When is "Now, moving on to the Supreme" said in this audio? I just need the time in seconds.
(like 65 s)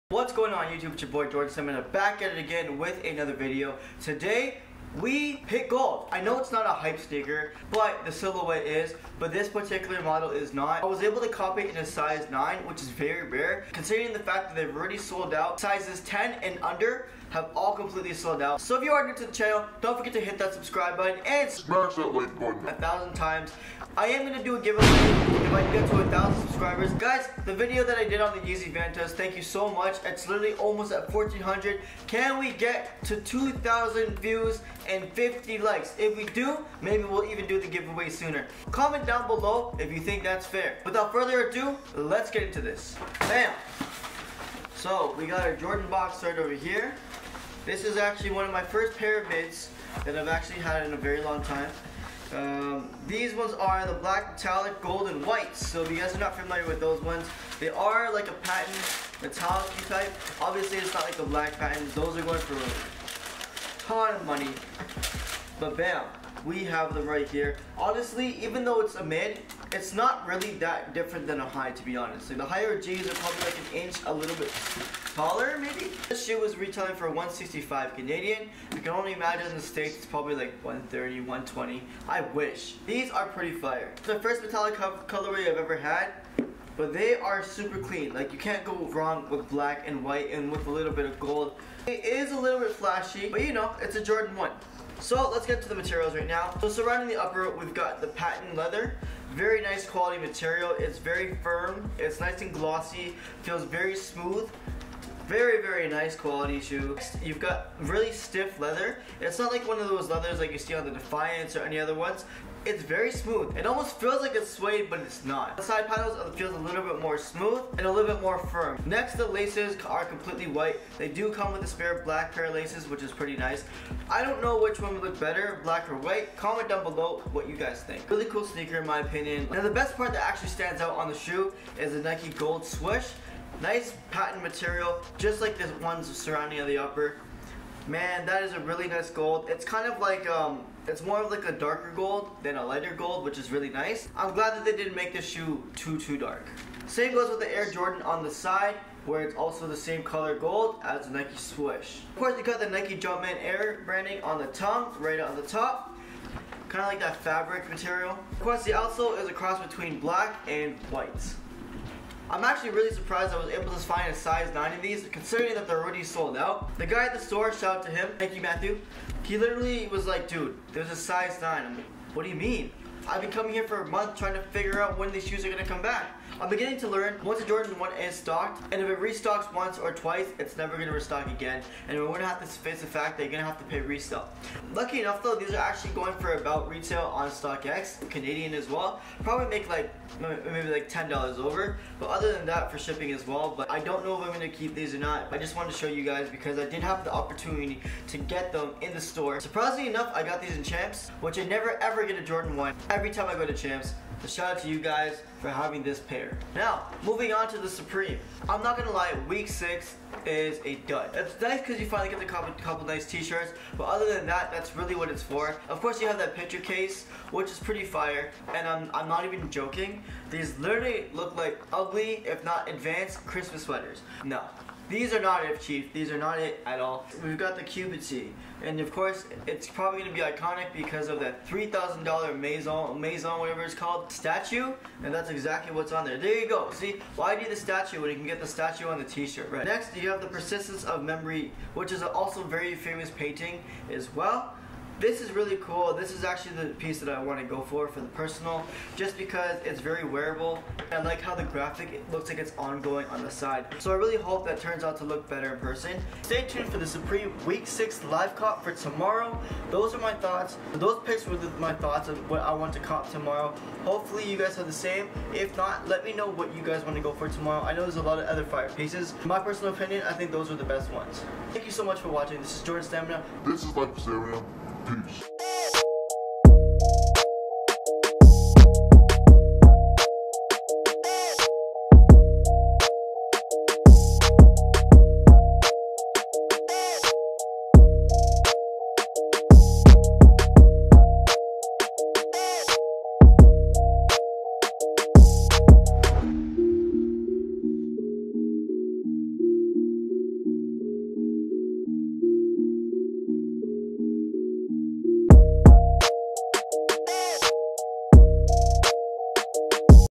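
206 s.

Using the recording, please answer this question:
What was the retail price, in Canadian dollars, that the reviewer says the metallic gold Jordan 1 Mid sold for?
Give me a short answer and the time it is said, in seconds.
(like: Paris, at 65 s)
165, at 77 s.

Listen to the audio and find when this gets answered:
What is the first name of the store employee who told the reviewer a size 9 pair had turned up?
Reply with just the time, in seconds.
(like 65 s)
168 s.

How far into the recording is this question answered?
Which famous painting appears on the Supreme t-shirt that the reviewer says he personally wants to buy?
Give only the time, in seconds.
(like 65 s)
240 s.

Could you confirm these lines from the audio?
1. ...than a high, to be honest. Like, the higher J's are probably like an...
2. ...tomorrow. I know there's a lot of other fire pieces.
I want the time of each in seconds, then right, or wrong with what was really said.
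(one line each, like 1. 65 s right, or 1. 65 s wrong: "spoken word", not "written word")
1. 71 s right
2. 267 s right.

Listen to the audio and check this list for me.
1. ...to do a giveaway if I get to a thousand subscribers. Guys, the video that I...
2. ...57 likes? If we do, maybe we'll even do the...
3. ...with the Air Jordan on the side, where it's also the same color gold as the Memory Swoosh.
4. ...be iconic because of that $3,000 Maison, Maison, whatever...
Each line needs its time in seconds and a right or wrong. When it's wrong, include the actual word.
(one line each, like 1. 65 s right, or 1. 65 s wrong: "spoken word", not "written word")
1. 24 s right
2. 35 s wrong: "50", not "57"
3. 147 s wrong: "Nike", not "Memory"
4. 230 s right.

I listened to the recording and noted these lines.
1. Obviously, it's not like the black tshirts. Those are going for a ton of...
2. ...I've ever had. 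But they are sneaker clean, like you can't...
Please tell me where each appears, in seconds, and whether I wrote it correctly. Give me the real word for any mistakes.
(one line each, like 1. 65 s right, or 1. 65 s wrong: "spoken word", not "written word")
1. 60 s wrong: "patents", not "tshirts"
2. 85 s wrong: "super", not "sneaker".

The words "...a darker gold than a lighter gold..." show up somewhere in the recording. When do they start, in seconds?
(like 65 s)
141 s.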